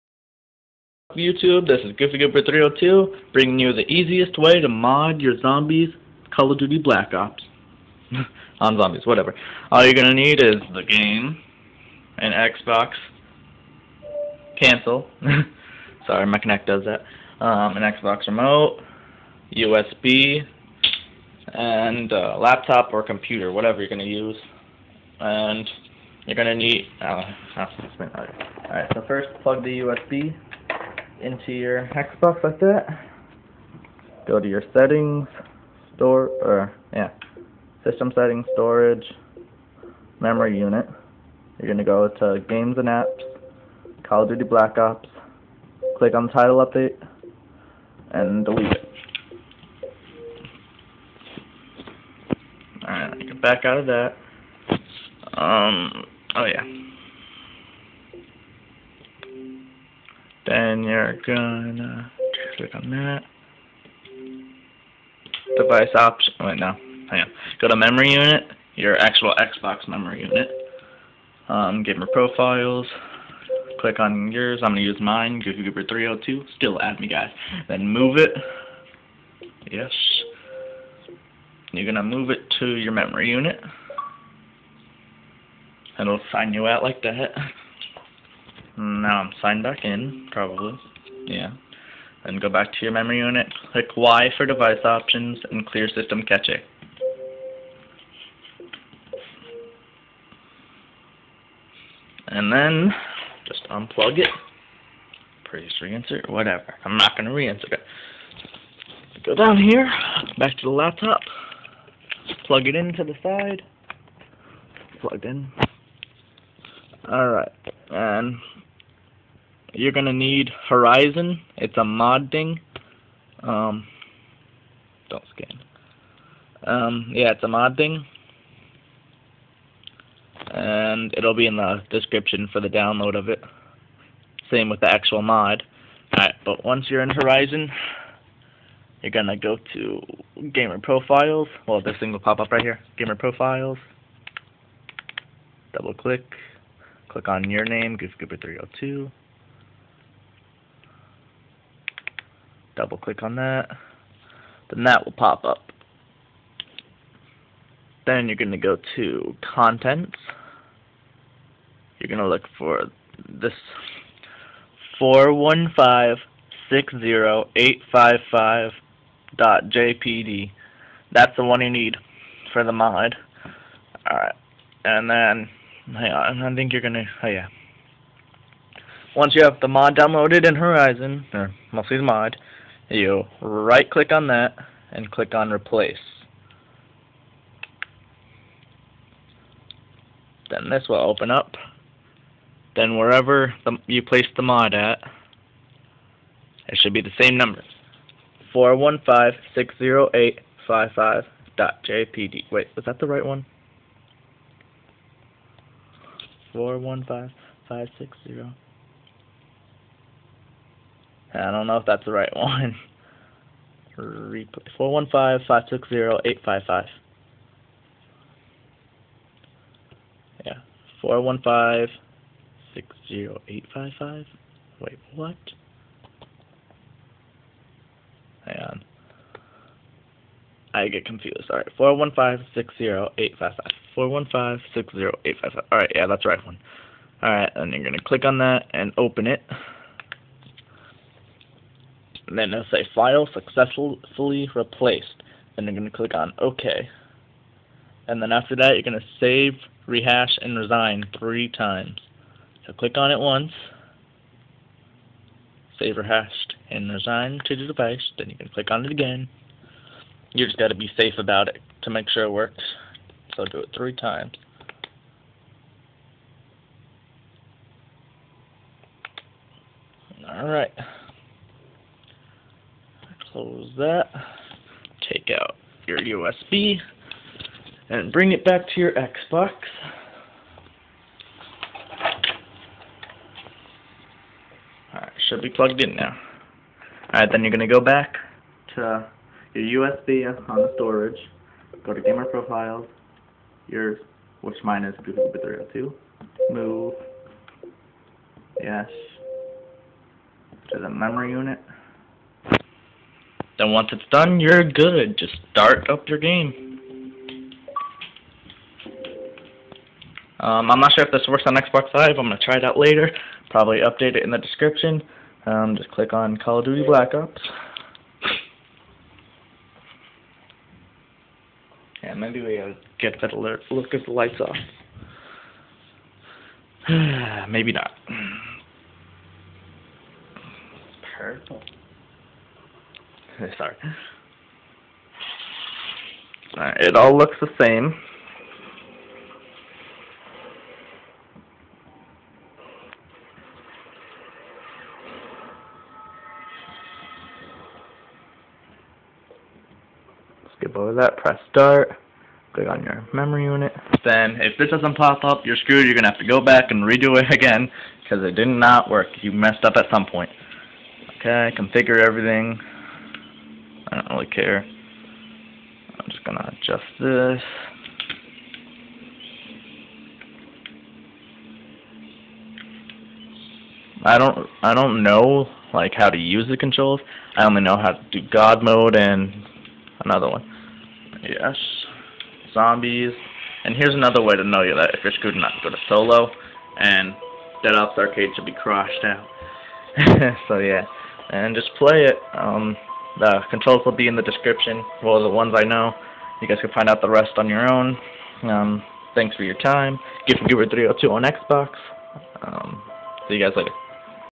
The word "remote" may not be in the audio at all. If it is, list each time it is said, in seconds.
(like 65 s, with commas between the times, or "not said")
18 s.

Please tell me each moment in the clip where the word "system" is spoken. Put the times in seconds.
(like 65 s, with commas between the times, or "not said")
37 s, 95 s.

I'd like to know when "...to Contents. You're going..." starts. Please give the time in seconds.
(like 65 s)
158 s.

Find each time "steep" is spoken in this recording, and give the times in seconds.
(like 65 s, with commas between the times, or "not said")
not said.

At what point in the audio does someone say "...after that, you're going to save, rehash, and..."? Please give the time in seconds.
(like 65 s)
248 s.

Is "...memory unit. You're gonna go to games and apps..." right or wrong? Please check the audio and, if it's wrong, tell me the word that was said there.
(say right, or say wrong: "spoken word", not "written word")
right.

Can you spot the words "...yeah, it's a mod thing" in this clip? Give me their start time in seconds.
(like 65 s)
127 s.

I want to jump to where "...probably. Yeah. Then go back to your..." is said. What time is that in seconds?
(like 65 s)
90 s.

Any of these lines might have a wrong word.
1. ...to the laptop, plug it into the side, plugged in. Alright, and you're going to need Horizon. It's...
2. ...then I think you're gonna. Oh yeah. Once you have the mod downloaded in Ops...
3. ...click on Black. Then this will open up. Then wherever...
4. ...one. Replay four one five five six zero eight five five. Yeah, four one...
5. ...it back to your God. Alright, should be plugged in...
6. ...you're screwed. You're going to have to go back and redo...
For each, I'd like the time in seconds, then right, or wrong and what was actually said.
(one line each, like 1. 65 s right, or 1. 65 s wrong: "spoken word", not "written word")
1. 110 s right
2. 175 s wrong: "Horizon", not "Ops"
3. 185 s wrong: "Replace", not "Black"
4. 212 s right
5. 278 s wrong: "Xbox", not "God"
6. 355 s right.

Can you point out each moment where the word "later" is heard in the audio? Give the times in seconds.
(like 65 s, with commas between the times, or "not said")
312 s, 403 s.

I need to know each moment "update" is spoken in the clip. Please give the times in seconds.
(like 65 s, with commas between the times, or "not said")
46 s, 313 s.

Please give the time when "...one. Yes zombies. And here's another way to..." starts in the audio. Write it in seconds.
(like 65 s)
380 s.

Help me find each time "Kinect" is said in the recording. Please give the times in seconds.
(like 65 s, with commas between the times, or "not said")
16 s.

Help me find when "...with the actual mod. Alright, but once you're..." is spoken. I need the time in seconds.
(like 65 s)
134 s.